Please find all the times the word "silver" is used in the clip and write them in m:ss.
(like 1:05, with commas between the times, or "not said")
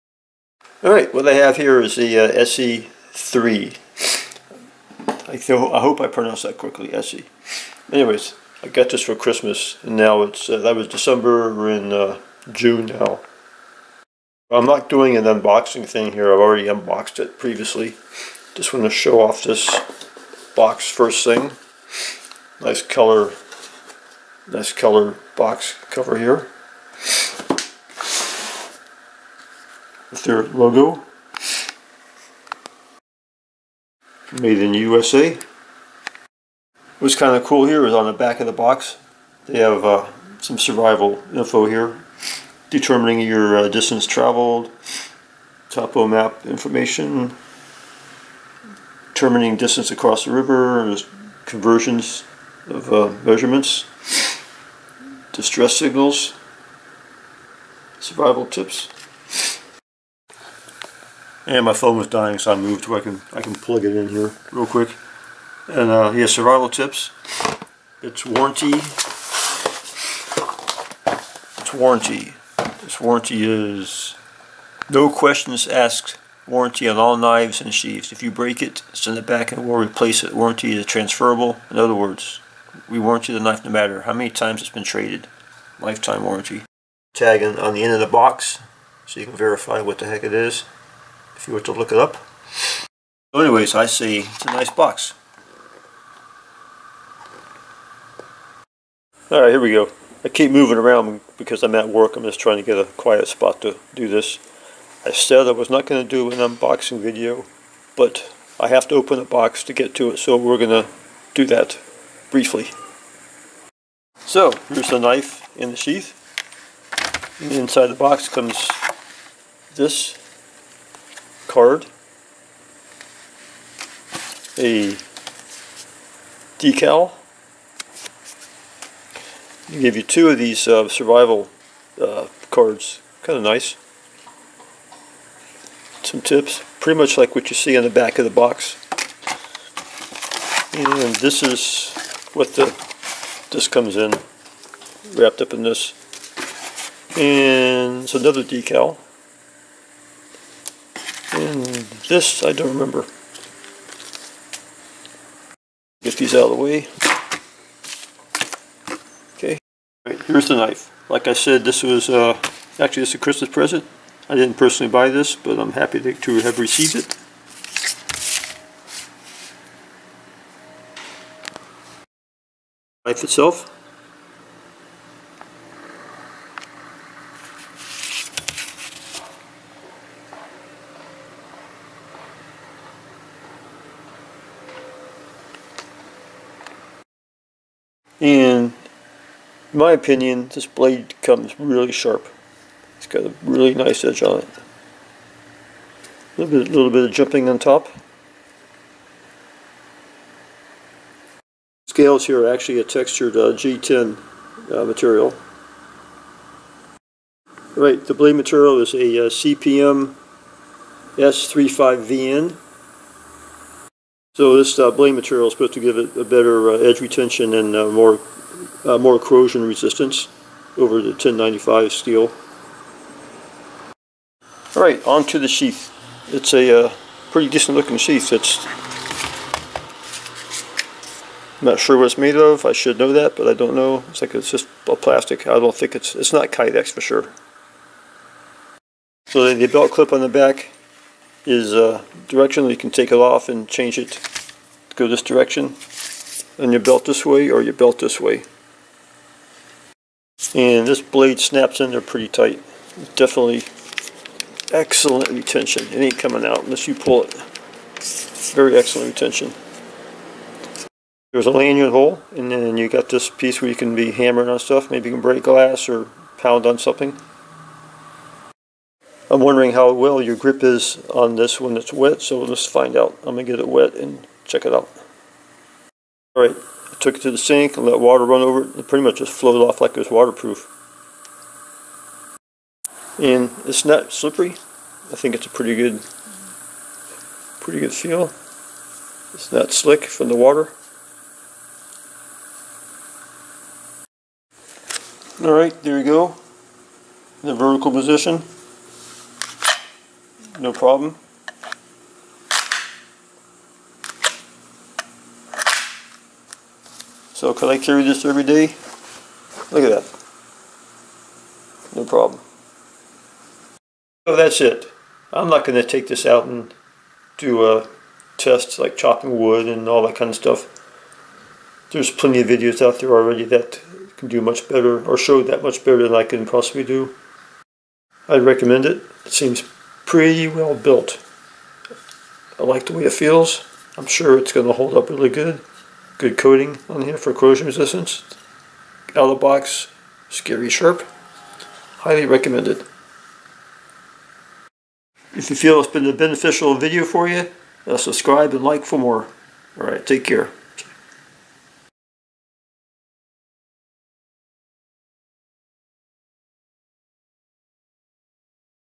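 not said.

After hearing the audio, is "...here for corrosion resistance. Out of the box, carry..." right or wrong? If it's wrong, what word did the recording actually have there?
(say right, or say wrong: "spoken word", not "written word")
wrong: "scary", not "carry".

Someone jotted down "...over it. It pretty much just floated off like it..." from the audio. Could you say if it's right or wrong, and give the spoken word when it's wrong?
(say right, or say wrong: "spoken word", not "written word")
right.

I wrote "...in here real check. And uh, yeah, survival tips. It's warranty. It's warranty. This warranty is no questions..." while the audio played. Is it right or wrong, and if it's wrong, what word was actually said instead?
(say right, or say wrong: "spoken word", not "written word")
wrong: "quick", not "check".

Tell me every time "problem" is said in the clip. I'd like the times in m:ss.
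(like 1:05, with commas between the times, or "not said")
5:00, 5:12.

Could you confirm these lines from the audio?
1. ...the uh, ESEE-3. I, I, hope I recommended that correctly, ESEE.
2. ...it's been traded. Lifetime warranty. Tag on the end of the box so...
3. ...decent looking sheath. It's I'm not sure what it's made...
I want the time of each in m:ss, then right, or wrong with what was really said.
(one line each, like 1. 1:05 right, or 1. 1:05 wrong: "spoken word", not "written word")
1. 0:01 wrong: "pronounced", not "recommended"
2. 1:24 right
3. 3:47 right.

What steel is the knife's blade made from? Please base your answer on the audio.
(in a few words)
CPM S35VN.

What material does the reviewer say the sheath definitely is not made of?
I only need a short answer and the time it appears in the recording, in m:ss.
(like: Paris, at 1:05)
Kydex, at 3:56.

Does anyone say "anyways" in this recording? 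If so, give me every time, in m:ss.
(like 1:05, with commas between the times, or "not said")
0:07, 1:33.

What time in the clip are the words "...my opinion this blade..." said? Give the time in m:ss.
3:09.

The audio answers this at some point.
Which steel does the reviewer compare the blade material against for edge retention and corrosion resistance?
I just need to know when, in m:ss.
3:41.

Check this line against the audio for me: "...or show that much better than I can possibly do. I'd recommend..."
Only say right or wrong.
right.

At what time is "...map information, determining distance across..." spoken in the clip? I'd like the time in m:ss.
0:46.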